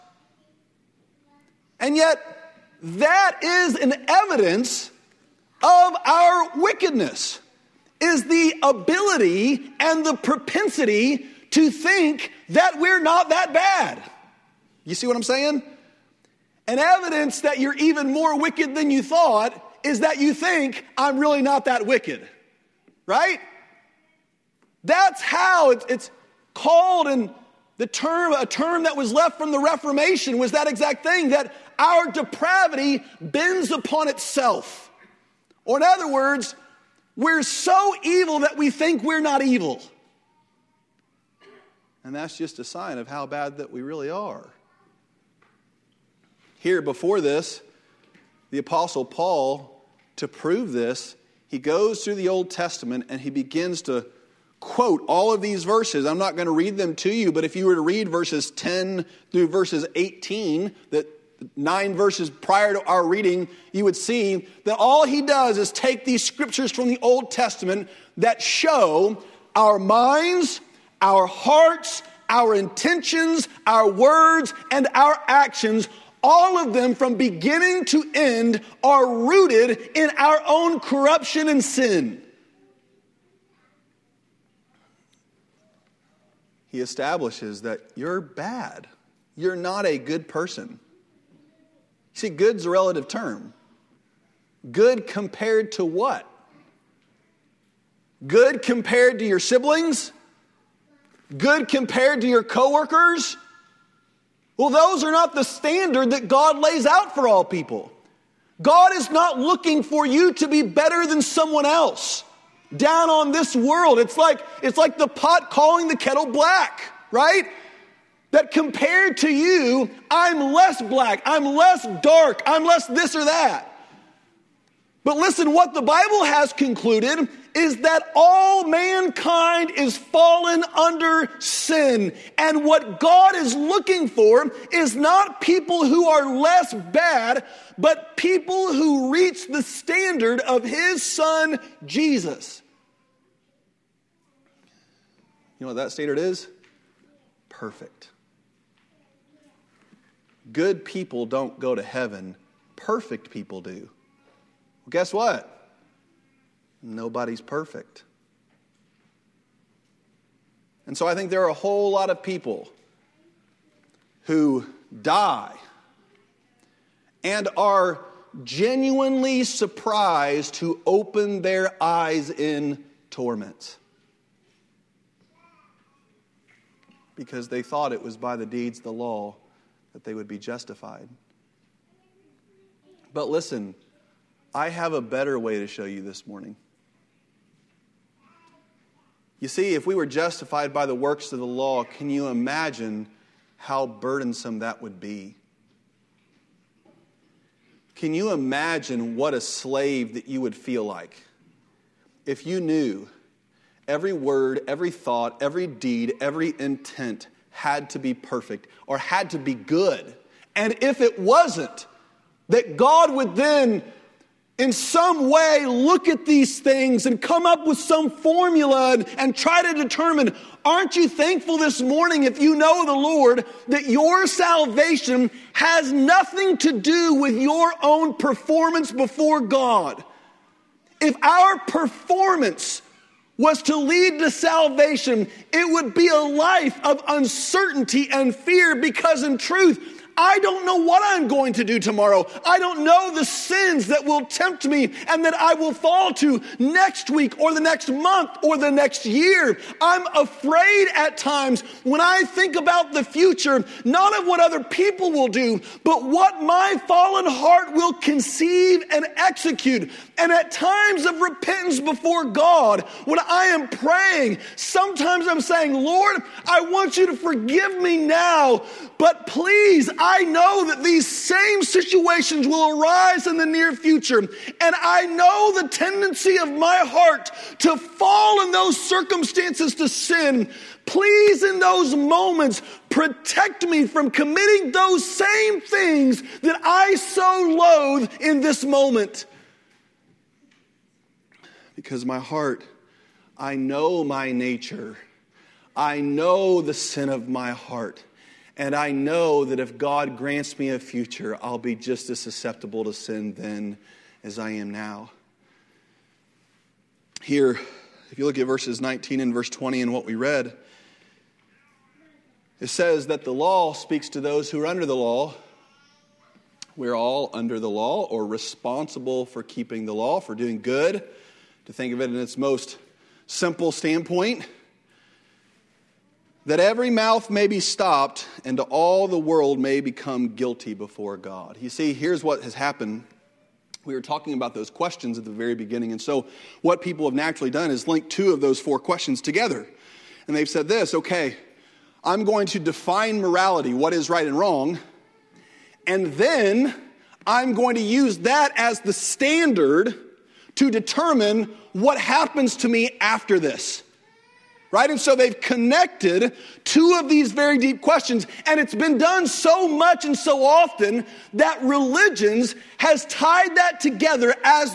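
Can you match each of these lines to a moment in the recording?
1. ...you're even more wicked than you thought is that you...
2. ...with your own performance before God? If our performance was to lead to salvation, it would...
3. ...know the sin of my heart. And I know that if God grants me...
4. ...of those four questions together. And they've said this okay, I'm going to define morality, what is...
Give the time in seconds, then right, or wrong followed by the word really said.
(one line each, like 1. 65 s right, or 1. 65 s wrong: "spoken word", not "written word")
1. 17 s right
2. 227 s right
3. 296 s right
4. 338 s right.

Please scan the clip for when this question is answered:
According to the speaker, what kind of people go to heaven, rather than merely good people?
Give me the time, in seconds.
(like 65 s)
152 s.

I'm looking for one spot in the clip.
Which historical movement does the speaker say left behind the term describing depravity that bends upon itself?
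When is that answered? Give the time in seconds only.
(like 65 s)
29 s.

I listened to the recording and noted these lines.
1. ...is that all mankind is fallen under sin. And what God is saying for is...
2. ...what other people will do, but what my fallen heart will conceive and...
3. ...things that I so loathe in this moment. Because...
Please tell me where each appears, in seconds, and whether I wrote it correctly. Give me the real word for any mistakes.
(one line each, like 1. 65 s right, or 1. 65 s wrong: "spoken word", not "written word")
1. 127 s wrong: "looking", not "saying"
2. 254 s right
3. 285 s right.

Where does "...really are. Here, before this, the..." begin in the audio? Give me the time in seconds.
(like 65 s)
43 s.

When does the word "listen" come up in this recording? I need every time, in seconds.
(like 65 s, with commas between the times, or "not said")
125 s, 183 s.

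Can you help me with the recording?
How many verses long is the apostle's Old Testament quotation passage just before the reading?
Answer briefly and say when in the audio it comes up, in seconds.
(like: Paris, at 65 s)
9, at 61 s.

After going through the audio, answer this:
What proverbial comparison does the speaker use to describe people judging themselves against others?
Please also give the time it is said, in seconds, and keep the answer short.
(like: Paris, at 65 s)
The pot calling the kettle black, at 114 s.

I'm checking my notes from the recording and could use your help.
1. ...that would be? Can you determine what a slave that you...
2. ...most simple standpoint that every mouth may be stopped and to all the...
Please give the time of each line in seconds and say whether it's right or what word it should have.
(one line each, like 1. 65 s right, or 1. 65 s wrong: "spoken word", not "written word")
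1. 194 s wrong: "imagine", not "determine"
2. 322 s right.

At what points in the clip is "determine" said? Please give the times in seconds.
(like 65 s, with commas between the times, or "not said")
219 s, 350 s.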